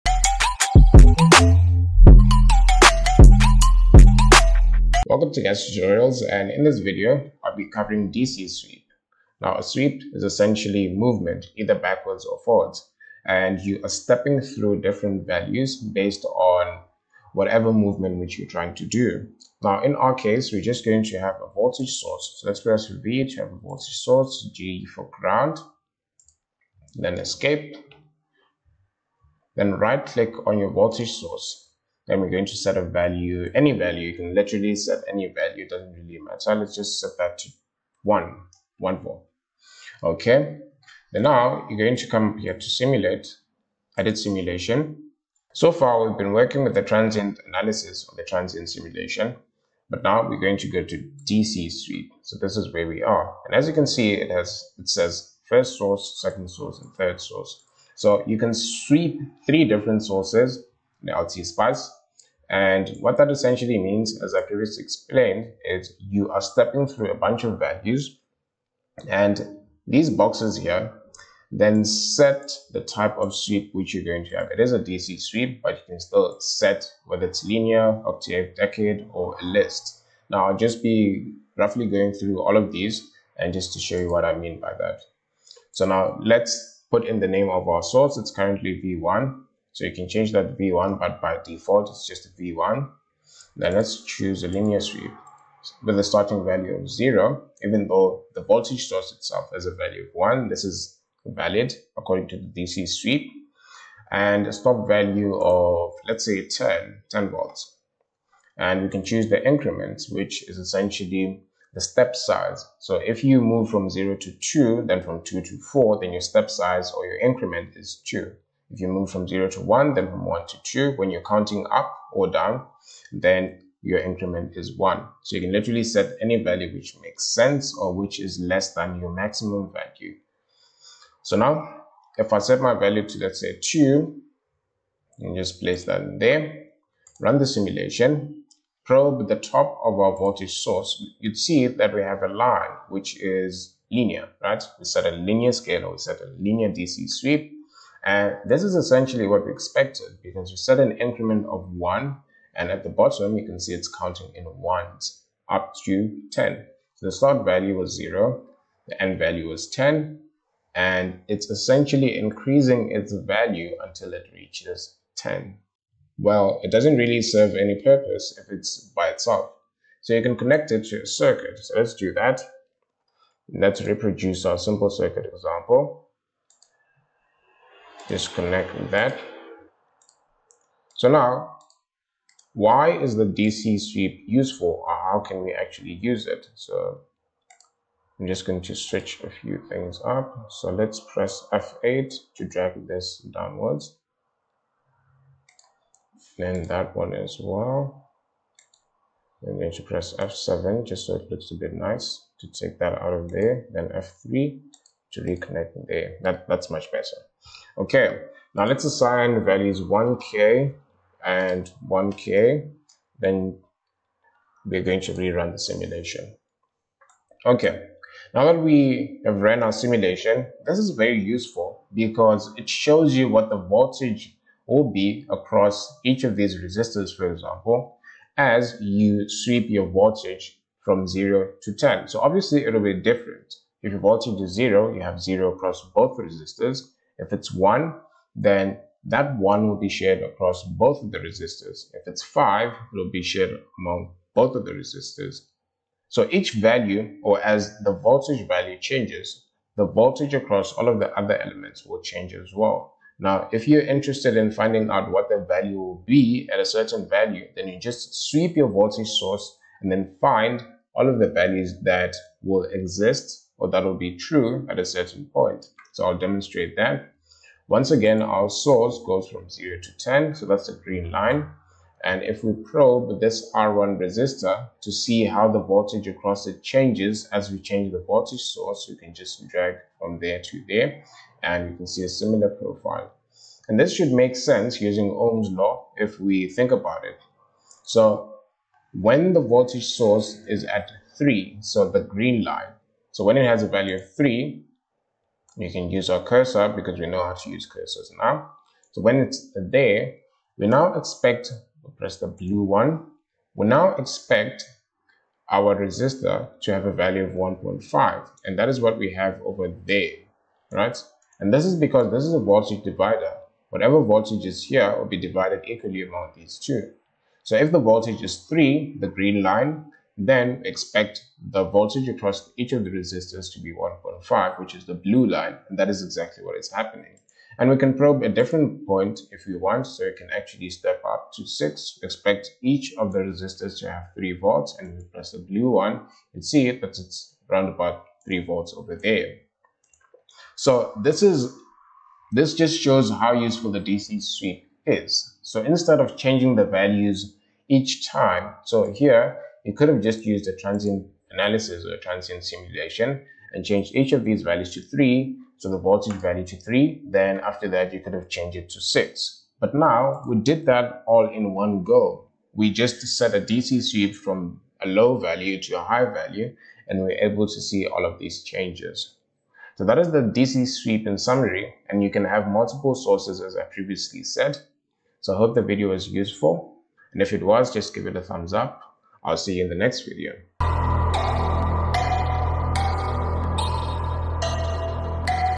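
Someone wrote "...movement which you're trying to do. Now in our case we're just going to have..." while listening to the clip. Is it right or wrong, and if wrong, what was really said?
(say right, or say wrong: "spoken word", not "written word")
right.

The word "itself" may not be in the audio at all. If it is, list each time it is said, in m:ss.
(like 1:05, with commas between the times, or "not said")
1:39, 2:49.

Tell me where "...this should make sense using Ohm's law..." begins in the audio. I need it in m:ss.
4:43.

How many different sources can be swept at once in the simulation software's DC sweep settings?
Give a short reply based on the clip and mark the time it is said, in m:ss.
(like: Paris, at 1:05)
3, at 0:59.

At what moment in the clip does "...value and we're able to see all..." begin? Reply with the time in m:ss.
6:06.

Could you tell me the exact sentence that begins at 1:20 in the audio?
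Now, I'll just be roughly going through all of these and just to show you what I mean by that.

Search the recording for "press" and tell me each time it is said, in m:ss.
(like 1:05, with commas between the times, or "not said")
0:22, 3:11, 3:19, 5:01, 5:35.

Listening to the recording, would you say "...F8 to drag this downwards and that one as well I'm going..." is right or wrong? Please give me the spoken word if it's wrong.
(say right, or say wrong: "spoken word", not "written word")
right.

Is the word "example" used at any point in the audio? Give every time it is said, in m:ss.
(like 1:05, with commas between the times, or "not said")
2:55, 3:47.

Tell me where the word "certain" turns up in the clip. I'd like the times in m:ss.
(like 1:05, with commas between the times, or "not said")
4:16, 4:24.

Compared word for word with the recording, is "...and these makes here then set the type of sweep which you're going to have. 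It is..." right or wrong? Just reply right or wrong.
wrong.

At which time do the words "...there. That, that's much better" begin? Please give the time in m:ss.
3:25.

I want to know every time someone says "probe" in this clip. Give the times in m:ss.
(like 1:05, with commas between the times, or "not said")
2:18, 4:32, 5:27.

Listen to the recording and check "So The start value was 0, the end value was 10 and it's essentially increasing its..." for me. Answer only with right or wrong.
right.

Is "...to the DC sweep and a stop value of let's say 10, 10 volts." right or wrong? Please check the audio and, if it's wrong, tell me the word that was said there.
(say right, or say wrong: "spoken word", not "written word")
right.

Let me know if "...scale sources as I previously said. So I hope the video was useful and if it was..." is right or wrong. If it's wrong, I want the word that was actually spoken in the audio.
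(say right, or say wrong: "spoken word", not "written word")
wrong: "multiple", not "scale".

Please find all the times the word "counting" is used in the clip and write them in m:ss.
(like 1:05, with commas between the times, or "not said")
2:01, 2:33.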